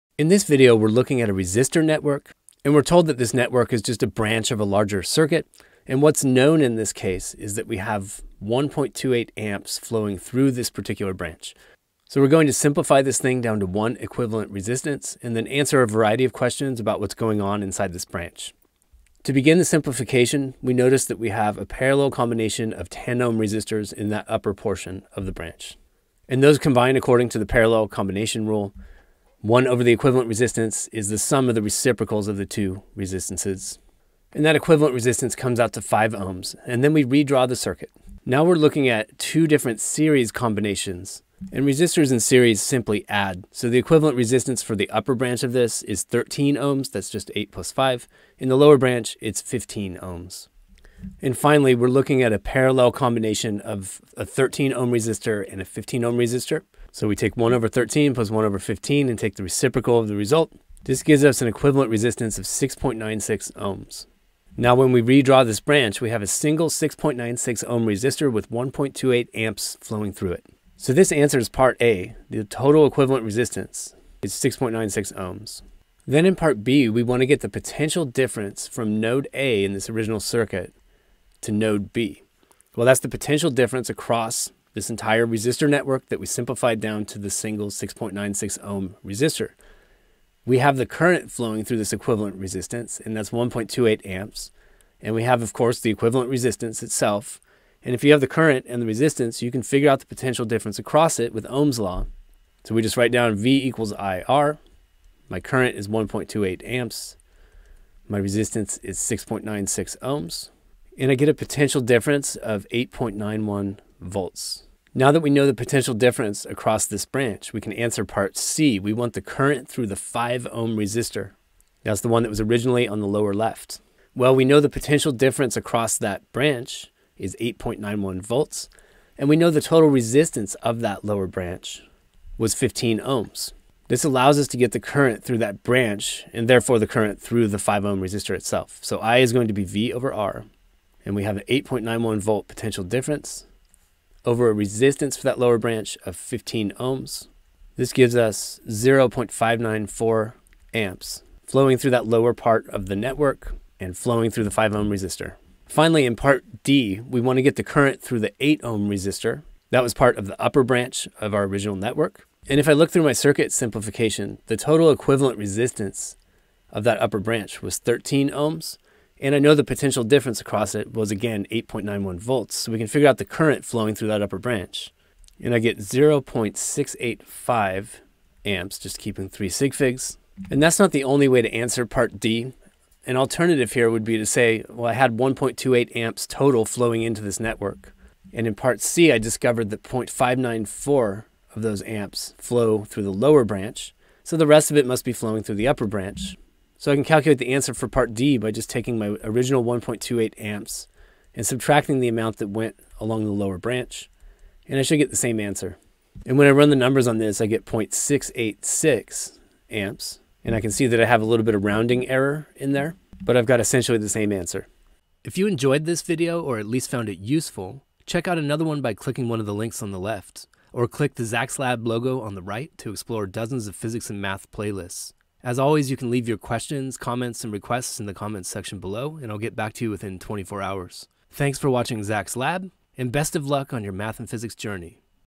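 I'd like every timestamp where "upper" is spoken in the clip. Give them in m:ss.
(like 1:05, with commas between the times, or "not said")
0:24, 0:44, 2:40, 2:47, 2:54, 3:15.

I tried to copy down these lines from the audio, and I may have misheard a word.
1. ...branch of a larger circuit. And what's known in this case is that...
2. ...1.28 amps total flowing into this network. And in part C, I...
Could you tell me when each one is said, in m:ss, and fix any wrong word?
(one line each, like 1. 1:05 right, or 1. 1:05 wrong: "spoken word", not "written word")
1. 0:04 right
2. 3:05 right.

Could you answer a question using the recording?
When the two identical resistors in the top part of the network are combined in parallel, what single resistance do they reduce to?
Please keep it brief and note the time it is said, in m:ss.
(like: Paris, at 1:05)
5 ohms, at 0:35.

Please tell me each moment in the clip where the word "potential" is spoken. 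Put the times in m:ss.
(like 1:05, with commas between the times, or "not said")
1:17, 1:23, 1:40, 1:51, 1:55, 2:04, 2:22, 2:49.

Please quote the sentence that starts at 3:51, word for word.
Thanks for watching Zak's Lab, and best of luck on your math and physics journey.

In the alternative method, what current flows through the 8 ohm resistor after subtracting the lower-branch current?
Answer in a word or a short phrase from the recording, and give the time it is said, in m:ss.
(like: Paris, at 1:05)
0.686 amps, at 3:27.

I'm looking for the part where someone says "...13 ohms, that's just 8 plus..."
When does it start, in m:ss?
0:46.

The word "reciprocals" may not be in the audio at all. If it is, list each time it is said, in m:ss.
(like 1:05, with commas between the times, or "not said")
0:31, 0:59.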